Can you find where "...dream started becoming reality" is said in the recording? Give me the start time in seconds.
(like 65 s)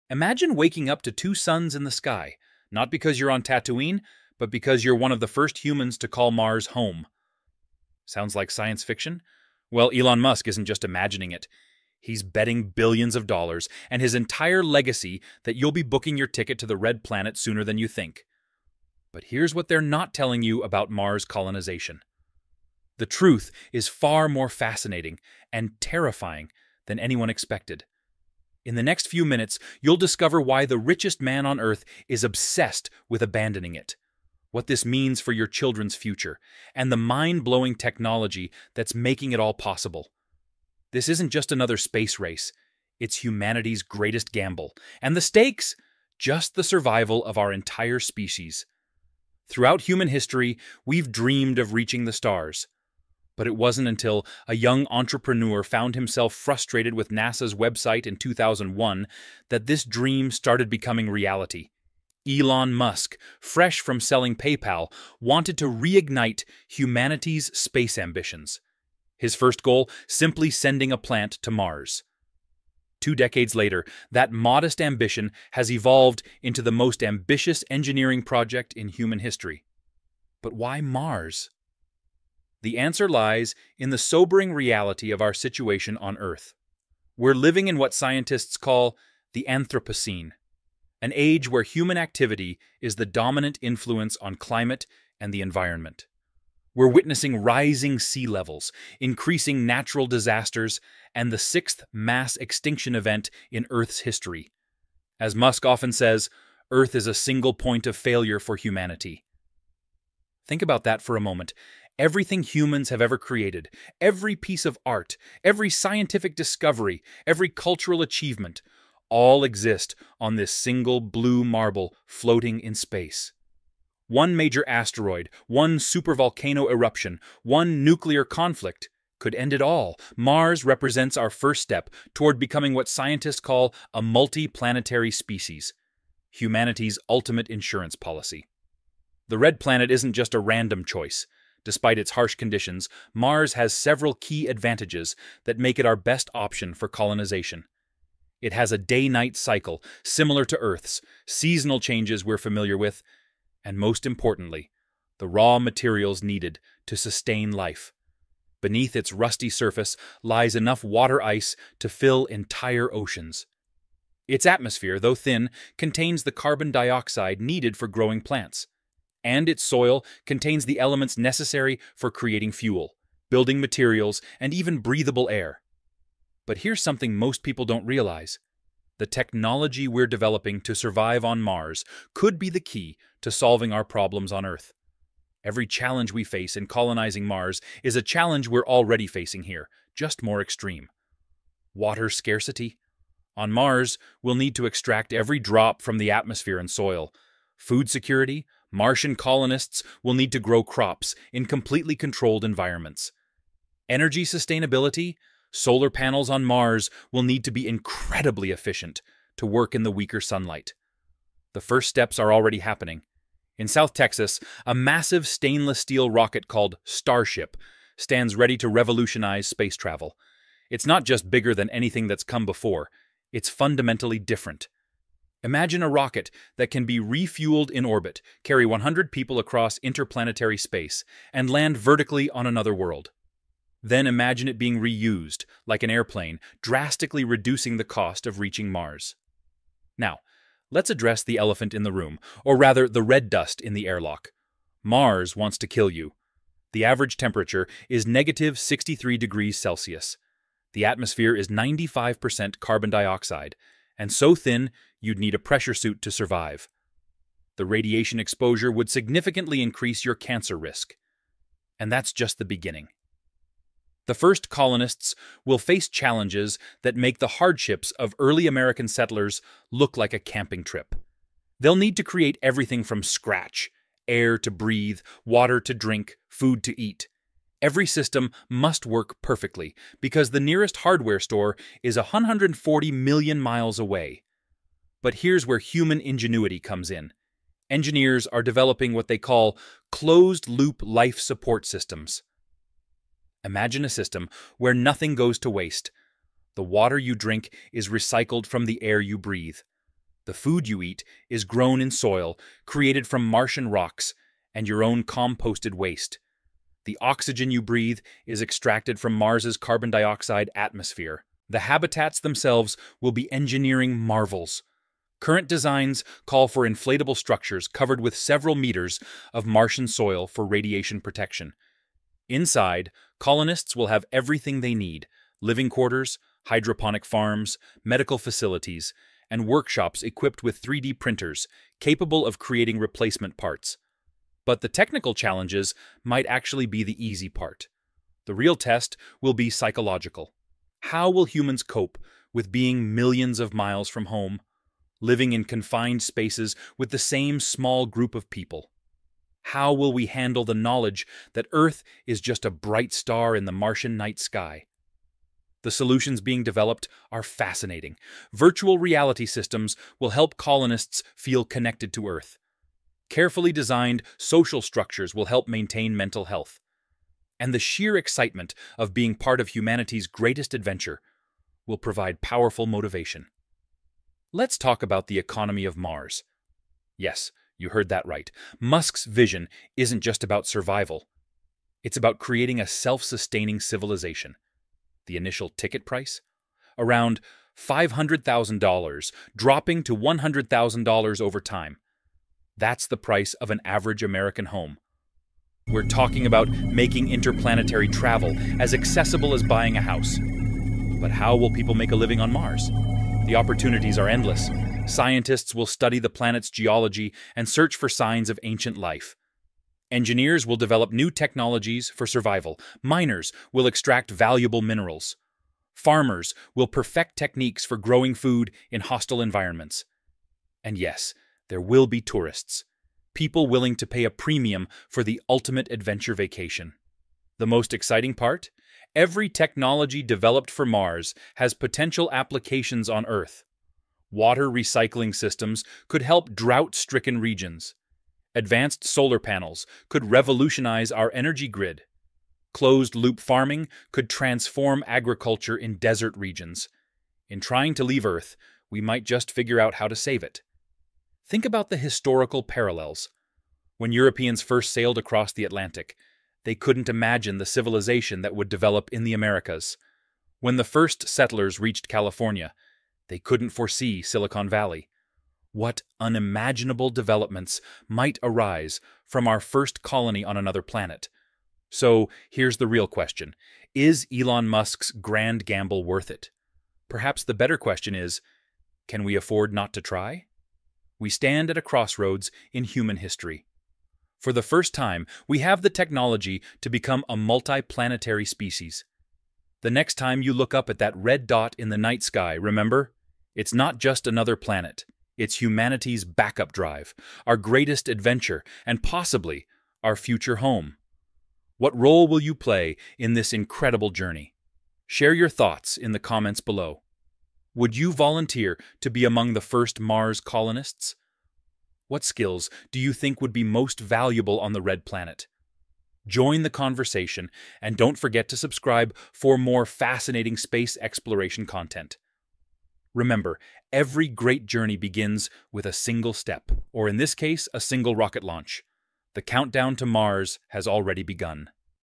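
59 s.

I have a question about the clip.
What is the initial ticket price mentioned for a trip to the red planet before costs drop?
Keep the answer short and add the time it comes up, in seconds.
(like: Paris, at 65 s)
$500,000, at 387 s.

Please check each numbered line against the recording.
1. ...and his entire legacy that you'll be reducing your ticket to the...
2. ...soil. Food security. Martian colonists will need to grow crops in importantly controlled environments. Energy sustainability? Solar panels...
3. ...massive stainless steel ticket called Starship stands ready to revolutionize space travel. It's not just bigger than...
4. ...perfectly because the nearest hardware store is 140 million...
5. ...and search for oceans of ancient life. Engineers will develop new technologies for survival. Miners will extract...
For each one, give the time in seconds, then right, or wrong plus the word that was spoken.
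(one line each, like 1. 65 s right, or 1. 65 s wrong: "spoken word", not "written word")
1. 13 s wrong: "booking", not "reducing"
2. 196 s wrong: "completely", not "importantly"
3. 214 s wrong: "rocket", not "ticket"
4. 279 s right
5. 407 s wrong: "signs", not "oceans".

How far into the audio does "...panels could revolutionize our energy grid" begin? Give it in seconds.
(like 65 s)
439 s.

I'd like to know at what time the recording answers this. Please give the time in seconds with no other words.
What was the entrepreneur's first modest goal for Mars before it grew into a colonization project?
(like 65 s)
70 s.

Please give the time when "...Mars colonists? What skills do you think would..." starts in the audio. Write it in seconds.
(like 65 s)
509 s.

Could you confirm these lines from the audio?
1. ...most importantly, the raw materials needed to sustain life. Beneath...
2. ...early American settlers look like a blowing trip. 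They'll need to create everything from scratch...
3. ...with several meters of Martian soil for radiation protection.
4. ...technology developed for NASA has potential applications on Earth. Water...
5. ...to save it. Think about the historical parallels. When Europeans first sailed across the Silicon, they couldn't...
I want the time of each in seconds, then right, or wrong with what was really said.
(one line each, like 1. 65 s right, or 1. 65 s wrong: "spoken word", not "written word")
1. 153 s right
2. 268 s wrong: "camping", not "blowing"
3. 318 s right
4. 429 s wrong: "Mars", not "NASA"
5. 449 s wrong: "Atlantic", not "Silicon".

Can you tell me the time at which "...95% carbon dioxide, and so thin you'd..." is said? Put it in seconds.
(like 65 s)
251 s.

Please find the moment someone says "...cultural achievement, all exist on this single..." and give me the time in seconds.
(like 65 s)
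117 s.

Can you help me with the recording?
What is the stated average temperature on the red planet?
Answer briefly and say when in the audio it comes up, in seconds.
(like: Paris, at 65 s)
-63 degrees Celsius, at 248 s.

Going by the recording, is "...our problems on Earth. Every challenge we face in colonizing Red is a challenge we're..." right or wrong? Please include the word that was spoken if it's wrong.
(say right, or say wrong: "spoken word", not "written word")
wrong: "Mars", not "Red".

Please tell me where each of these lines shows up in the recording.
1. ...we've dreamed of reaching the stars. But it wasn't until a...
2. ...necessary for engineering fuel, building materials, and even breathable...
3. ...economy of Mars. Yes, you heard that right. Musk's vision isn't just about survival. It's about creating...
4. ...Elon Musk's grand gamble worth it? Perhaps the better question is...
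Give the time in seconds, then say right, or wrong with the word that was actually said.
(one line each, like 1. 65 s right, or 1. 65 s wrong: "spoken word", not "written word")
1. 50 s right
2. 171 s wrong: "creating", not "engineering"
3. 375 s right
4. 474 s right.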